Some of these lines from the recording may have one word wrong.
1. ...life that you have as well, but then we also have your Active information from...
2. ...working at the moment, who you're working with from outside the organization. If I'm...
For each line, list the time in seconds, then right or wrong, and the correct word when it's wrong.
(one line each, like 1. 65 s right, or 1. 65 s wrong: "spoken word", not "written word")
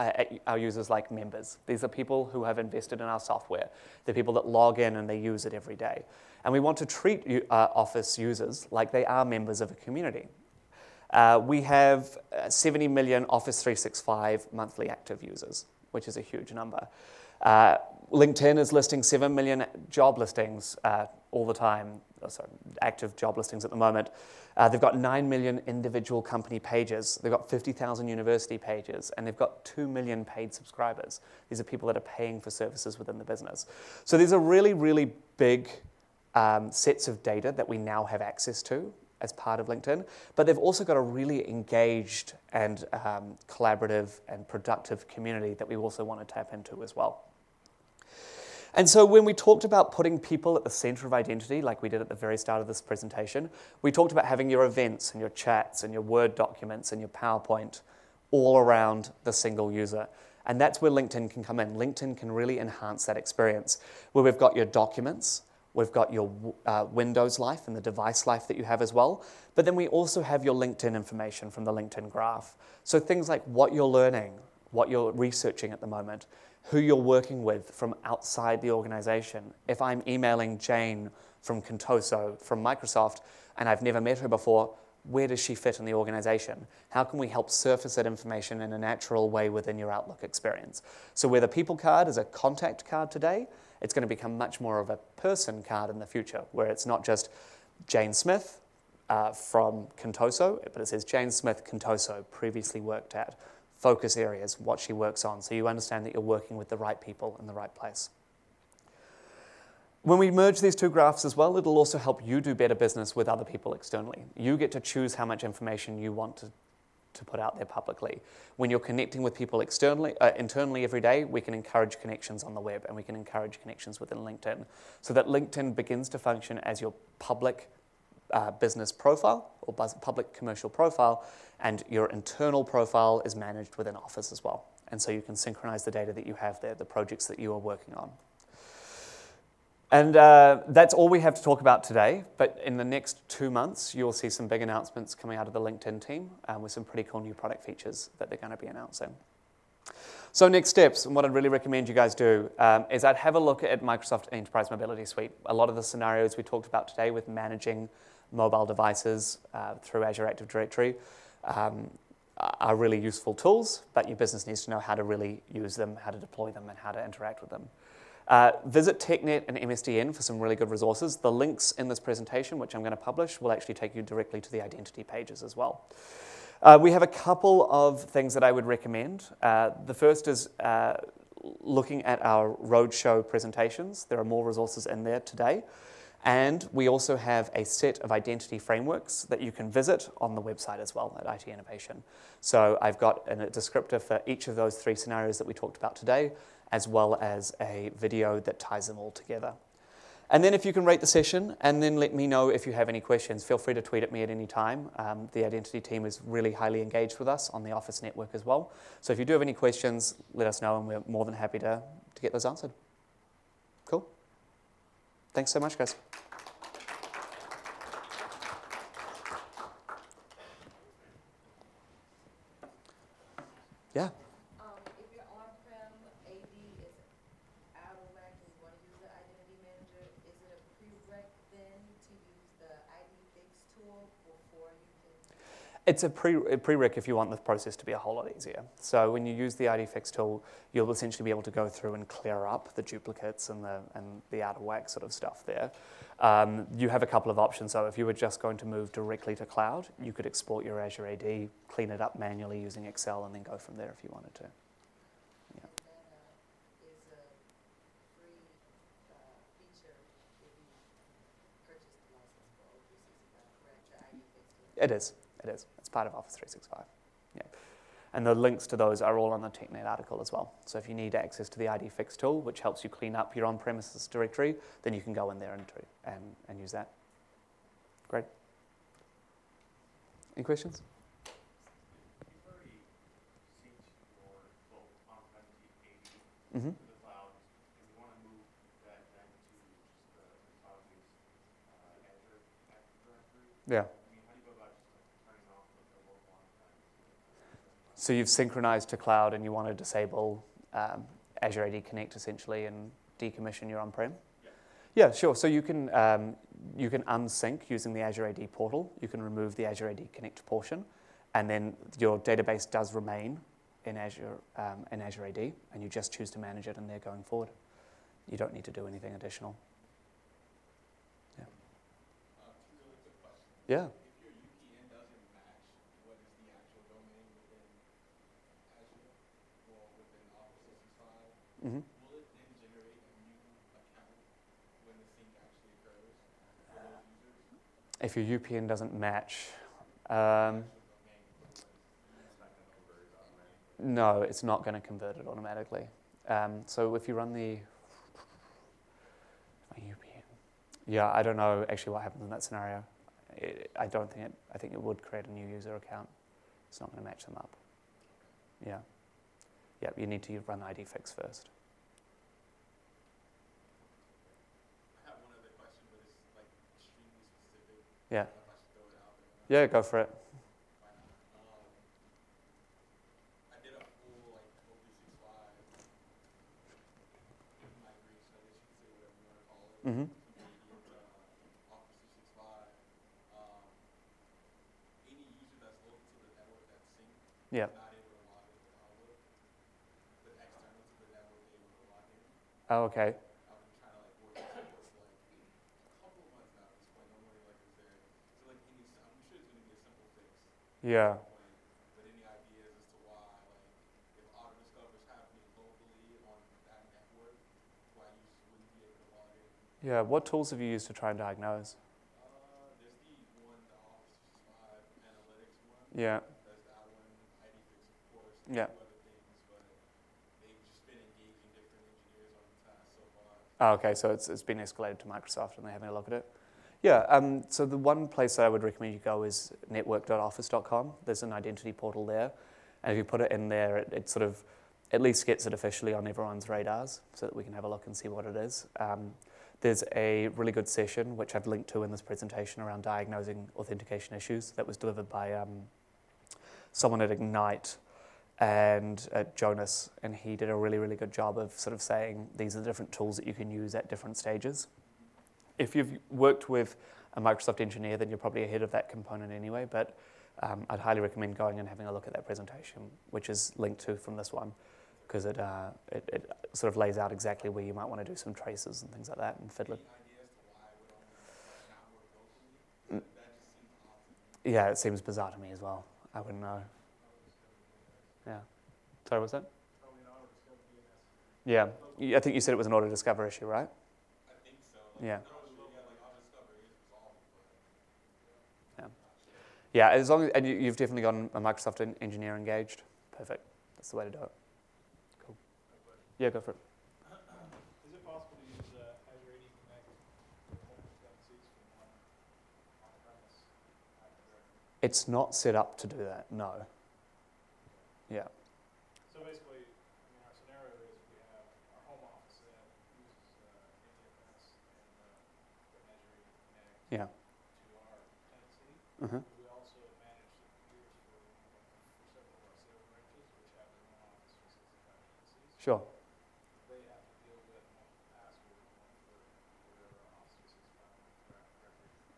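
1. 68 s wrong: "LinkedIn", not "Active"
2. 75 s wrong: "researching", not "working".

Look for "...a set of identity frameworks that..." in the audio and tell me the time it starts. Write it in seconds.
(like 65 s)
187 s.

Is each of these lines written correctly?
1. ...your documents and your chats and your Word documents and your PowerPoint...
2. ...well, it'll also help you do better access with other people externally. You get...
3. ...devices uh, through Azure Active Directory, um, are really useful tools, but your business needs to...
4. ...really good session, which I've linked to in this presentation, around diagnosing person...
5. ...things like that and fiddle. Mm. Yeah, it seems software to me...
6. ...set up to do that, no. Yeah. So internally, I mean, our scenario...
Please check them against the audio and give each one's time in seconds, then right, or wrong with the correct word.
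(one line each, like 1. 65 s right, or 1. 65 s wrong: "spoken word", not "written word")
1. 54 s wrong: "events", not "documents"
2. 111 s wrong: "business", not "access"
3. 158 s right
4. 440 s wrong: "authentication", not "person"
5. 468 s wrong: "bizarre", not "software"
6. 505 s wrong: "basically", not "internally".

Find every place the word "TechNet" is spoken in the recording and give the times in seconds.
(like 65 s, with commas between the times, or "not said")
168 s, 269 s.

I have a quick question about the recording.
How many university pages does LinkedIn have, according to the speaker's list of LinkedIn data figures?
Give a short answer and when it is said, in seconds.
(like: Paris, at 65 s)
50,000, at 27 s.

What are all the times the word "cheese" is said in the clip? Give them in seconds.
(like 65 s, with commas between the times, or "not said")
not said.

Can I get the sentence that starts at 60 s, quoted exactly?
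And that's where LinkedIn can come in.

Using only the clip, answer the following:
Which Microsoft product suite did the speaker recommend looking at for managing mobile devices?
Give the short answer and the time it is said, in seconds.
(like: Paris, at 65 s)
Enterprise Mobility Suite, at 154 s.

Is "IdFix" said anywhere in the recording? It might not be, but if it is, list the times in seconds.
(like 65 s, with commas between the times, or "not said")
239 s, 271 s.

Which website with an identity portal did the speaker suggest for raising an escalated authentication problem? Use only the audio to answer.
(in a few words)
network.office.com.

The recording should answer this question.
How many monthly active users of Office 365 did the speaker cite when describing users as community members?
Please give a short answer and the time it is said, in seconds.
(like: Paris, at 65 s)
70 million, at 12 s.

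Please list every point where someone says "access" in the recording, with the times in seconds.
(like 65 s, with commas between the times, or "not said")
38 s, 271 s.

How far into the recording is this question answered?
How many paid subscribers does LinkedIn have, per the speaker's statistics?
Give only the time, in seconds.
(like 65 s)
29 s.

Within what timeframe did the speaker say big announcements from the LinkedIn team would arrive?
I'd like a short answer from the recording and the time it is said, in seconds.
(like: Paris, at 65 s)
Two months, at 142 s.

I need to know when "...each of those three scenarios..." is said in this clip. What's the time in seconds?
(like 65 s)
194 s.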